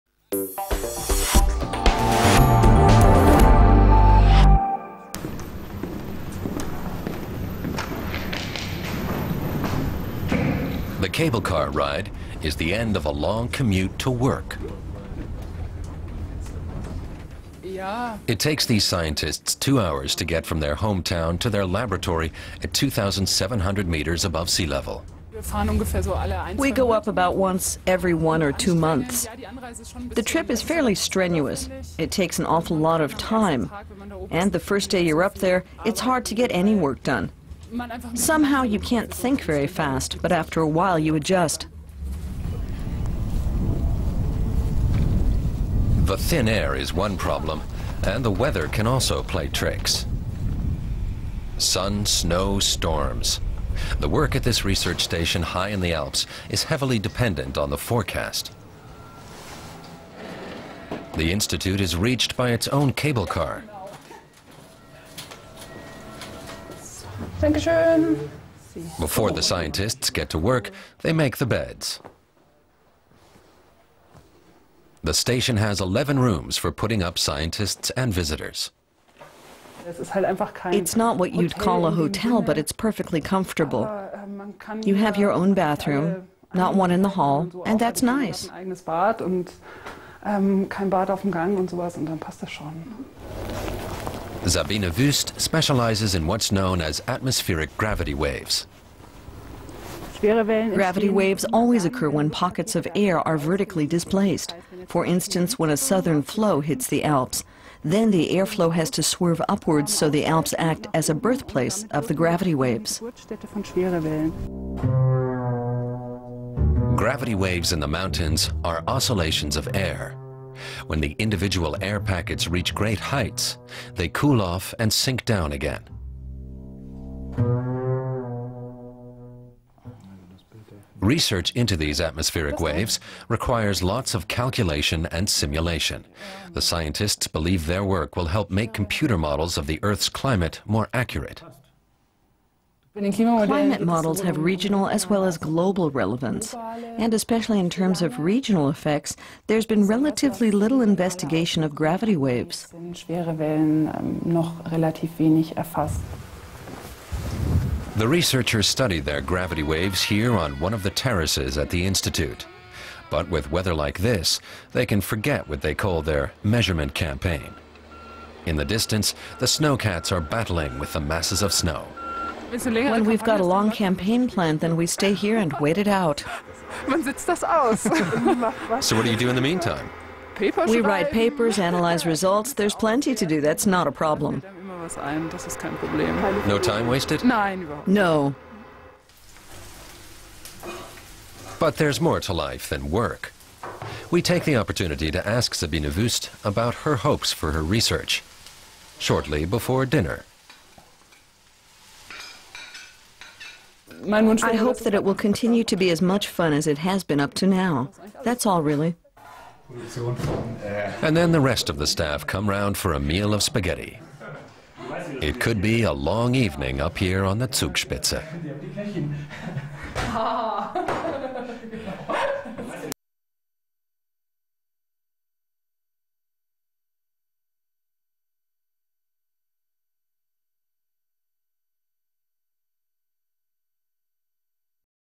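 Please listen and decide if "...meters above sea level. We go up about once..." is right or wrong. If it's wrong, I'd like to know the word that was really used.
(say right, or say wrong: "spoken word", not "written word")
right.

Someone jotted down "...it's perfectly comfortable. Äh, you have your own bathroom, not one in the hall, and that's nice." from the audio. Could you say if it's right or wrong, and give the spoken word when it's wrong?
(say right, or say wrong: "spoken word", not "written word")
right.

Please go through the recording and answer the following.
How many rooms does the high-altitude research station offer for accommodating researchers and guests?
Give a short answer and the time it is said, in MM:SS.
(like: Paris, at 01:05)
11, at 01:15.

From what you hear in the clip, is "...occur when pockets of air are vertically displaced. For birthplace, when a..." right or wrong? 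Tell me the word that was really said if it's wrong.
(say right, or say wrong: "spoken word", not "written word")
wrong: "instance", not "birthplace".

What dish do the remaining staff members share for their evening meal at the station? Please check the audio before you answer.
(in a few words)
Spaghetti.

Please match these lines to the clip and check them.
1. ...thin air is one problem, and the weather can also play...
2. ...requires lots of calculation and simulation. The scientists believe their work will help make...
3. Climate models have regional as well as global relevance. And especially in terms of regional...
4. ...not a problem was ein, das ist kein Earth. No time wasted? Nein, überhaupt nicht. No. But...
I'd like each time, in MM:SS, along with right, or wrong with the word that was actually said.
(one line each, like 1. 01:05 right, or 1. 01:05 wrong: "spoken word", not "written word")
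1. 00:46 right
2. 02:13 right
3. 02:22 right
4. 03:03 wrong: "Problem", not "Earth".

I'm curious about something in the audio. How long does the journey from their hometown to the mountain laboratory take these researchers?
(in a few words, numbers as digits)
2 hours.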